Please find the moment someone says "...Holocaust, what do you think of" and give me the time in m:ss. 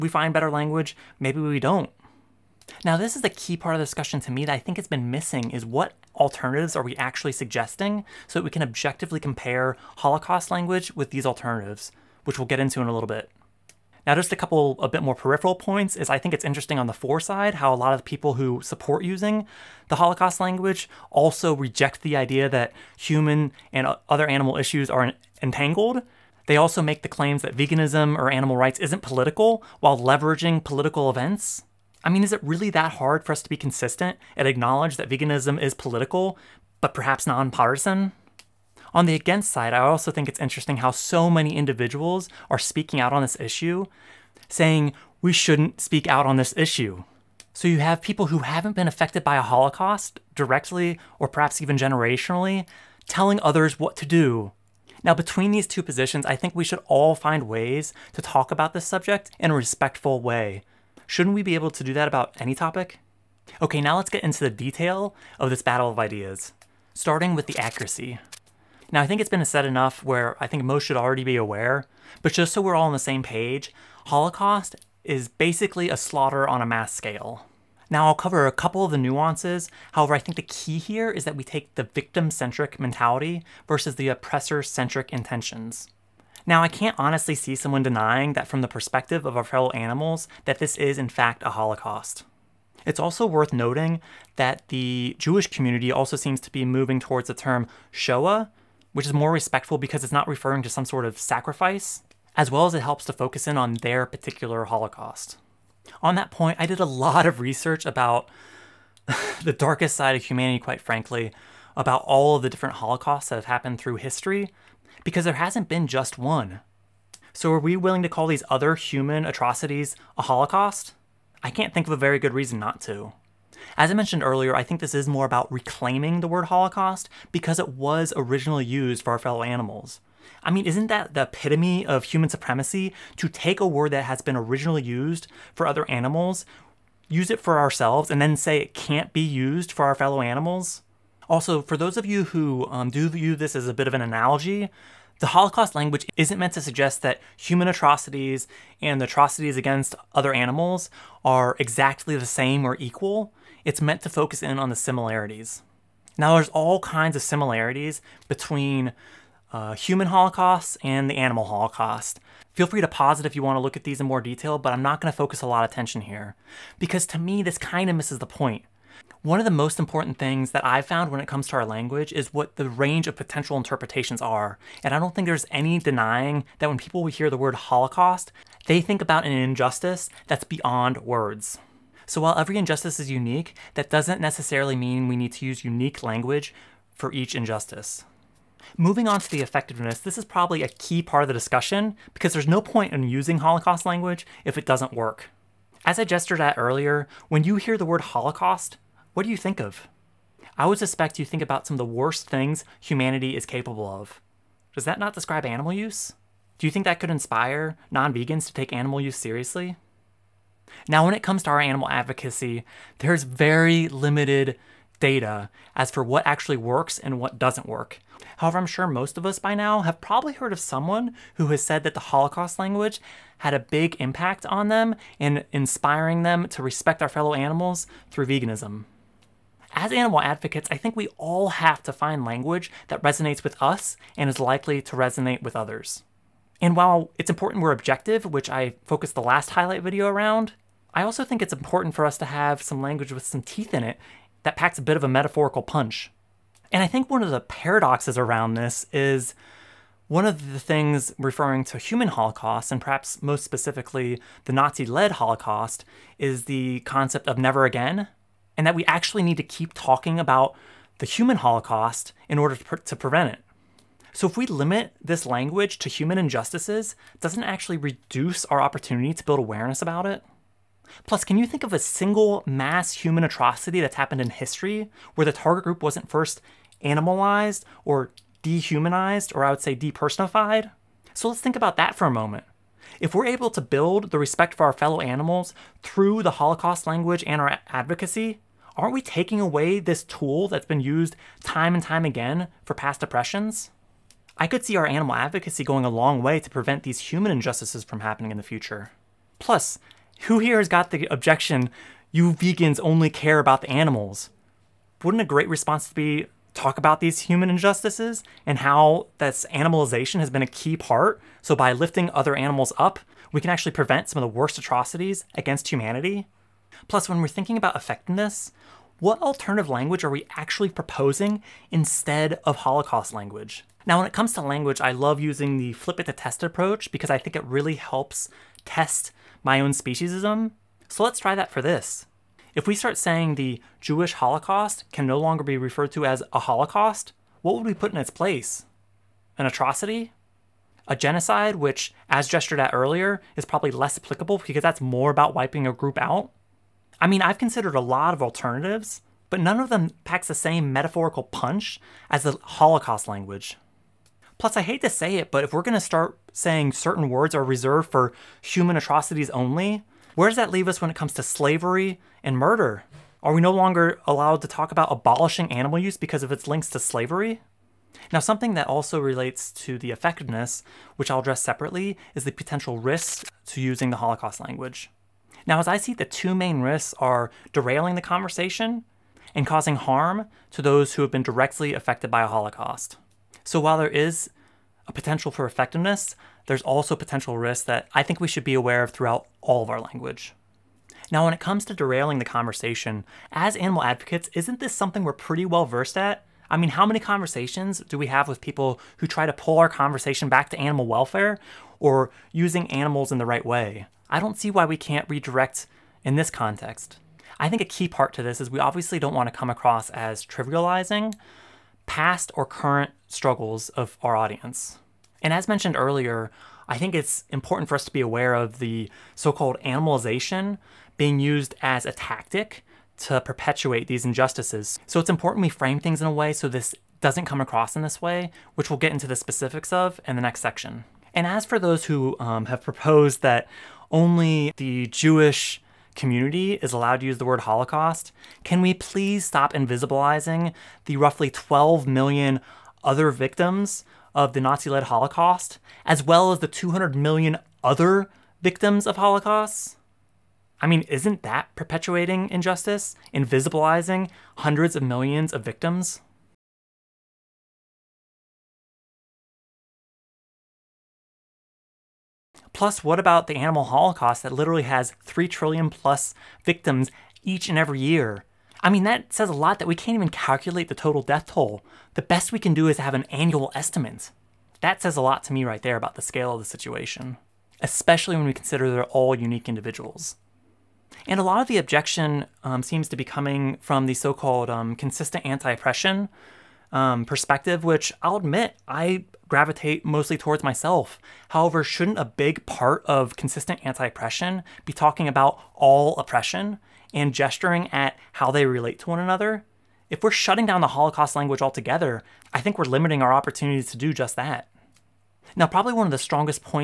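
3:18.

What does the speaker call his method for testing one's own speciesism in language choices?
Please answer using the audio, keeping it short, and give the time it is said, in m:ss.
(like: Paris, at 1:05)
flip it to test, at 5:25.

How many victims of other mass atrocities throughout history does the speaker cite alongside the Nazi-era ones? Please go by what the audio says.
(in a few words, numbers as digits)
200 million.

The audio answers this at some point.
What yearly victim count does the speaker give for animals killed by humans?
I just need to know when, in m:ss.
7:45.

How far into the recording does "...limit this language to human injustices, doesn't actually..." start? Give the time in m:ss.
4:24.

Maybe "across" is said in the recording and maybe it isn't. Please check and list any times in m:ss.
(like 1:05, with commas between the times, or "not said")
6:49, 7:07.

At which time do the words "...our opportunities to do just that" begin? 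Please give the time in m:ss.
8:23.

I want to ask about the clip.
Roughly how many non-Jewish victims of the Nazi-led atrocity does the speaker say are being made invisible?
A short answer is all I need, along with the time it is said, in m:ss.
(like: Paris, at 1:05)
12 million, at 7:21.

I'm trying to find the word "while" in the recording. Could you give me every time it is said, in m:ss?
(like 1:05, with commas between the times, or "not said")
0:29, 3:02, 3:56, 6:23.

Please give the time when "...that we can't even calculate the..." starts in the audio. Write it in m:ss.
7:49.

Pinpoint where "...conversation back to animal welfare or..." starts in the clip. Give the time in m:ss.
6:39.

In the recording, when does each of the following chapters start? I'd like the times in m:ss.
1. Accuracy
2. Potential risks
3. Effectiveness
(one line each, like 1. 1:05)
1. 1:03
2. 6:07
3. 3:08.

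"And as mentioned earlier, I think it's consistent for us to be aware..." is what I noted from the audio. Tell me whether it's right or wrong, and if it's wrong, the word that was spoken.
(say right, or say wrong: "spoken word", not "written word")
wrong: "important", not "consistent".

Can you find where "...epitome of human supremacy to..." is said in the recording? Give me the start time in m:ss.
2:11.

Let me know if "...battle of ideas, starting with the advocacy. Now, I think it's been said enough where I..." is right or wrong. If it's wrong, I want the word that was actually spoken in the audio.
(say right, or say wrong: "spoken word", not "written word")
wrong: "accuracy", not "advocacy".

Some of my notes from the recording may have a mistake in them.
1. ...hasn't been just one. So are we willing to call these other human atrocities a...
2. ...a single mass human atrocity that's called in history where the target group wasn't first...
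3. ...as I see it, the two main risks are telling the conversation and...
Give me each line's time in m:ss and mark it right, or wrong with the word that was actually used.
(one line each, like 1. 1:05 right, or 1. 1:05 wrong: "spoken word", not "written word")
1. 1:55 right
2. 4:31 wrong: "happened", not "called"
3. 6:15 wrong: "derailing", not "telling".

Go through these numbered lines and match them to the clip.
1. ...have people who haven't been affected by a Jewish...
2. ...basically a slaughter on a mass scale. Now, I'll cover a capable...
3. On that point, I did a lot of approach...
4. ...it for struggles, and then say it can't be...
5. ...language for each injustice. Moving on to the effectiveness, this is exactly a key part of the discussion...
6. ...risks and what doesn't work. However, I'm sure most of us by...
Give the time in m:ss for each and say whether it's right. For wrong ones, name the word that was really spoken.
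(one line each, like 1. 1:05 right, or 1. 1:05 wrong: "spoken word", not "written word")
1. 0:47 wrong: "Holocaust", not "Jewish"
2. 1:15 wrong: "couple", not "capable"
3. 1:46 wrong: "research", not "approach"
4. 2:17 wrong: "ourselves", not "struggles"
5. 3:06 wrong: "probably", not "exactly"
6. 3:36 wrong: "works", not "risks".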